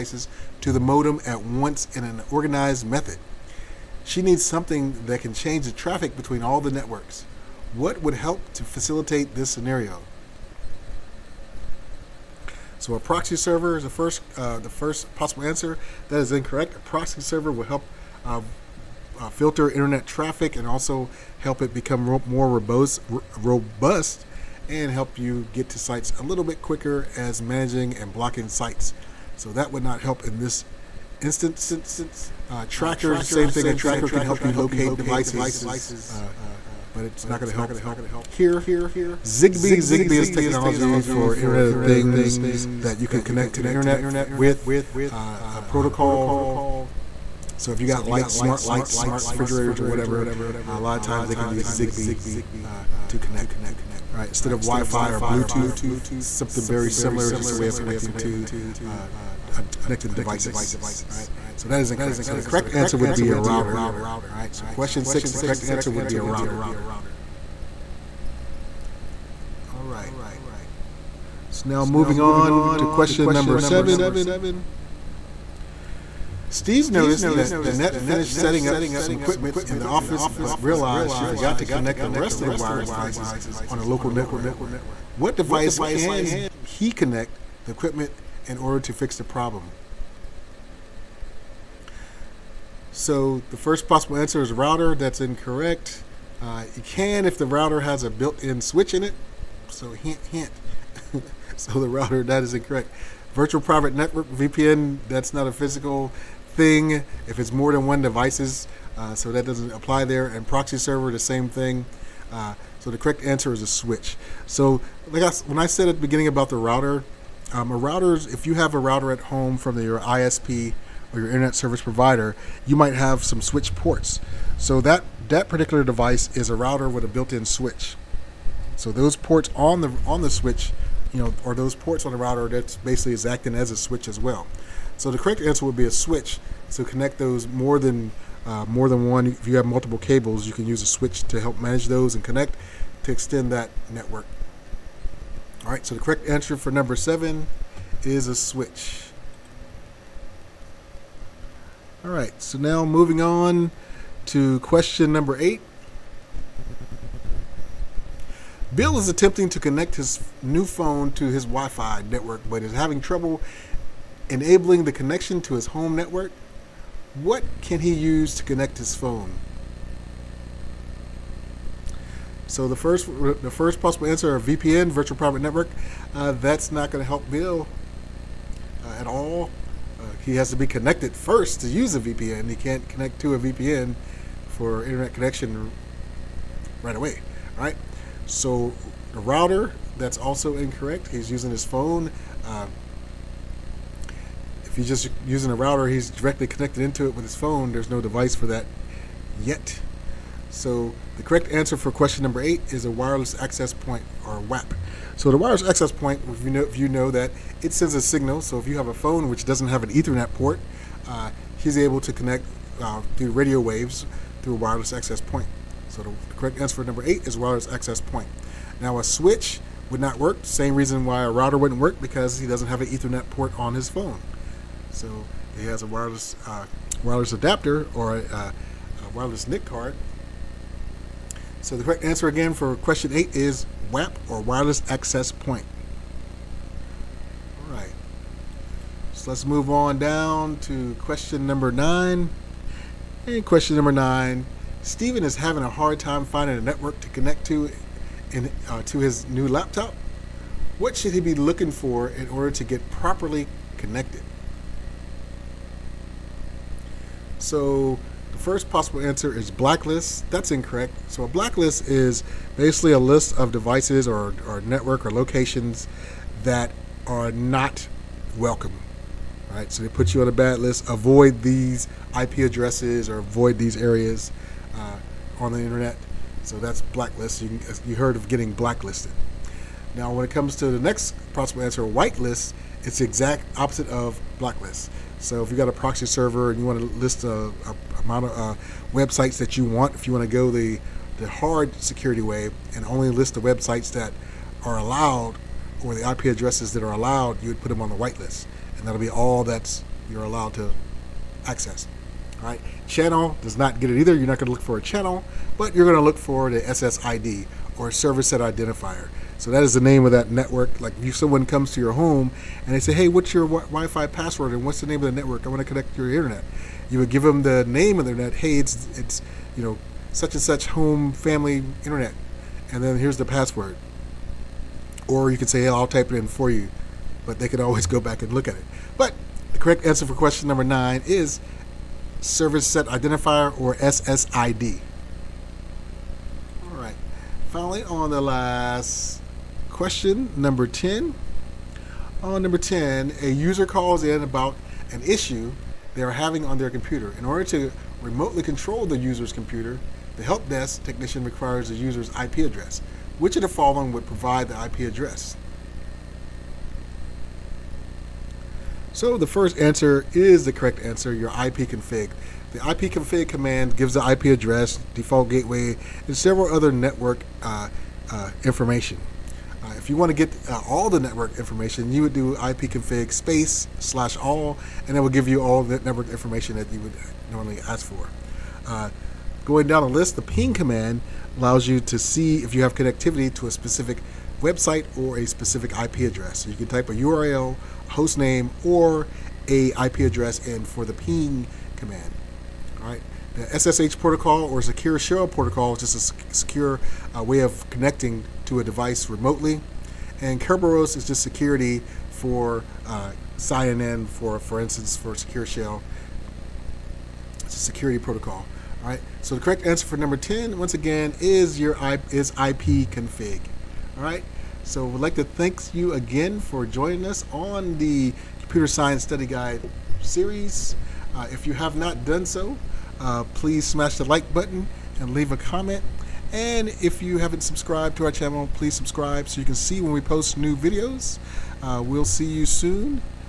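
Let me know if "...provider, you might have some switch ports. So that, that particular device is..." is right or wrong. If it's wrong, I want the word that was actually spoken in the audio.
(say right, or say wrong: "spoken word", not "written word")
right.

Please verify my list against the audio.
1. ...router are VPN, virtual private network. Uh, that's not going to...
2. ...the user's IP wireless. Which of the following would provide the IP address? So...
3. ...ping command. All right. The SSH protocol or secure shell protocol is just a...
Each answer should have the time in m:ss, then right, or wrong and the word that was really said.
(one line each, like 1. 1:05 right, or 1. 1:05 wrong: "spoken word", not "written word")
1. 2:54 wrong: "answer", not "router"
2. 5:51 wrong: "address", not "wireless"
3. 6:30 right.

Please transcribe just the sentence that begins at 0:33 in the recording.
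A tracker can help you locate devices, uh, but it's not going to help here.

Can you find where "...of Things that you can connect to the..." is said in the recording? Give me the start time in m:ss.
0:41.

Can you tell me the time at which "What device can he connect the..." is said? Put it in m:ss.
1:25.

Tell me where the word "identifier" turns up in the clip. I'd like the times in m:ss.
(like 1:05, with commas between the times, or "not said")
5:08, 5:32.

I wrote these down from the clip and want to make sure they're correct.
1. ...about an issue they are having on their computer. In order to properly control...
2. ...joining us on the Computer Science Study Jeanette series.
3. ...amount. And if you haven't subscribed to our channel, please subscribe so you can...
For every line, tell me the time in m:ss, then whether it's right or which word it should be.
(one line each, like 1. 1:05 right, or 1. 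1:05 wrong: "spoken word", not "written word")
1. 5:44 wrong: "remotely", not "properly"
2. 6:56 wrong: "Guide", not "Jeanette"
3. 7:05 wrong: "comment", not "amount".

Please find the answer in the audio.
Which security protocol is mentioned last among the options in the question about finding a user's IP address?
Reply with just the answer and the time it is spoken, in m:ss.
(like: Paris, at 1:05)
Kerberos, at 6:40.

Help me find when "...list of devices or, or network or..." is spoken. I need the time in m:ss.
4:22.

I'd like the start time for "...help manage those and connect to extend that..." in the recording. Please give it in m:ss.
2:21.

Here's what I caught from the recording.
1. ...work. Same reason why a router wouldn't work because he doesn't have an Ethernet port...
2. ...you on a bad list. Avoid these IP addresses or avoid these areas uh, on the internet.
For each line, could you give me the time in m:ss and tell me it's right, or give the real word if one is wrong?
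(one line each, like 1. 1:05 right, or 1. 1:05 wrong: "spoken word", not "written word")
1. 3:40 right
2. 4:30 right.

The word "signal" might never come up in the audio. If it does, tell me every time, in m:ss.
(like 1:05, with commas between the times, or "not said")
3:28.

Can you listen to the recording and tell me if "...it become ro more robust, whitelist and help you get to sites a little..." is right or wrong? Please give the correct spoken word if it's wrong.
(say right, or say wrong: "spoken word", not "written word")
wrong: "robust", not "whitelist".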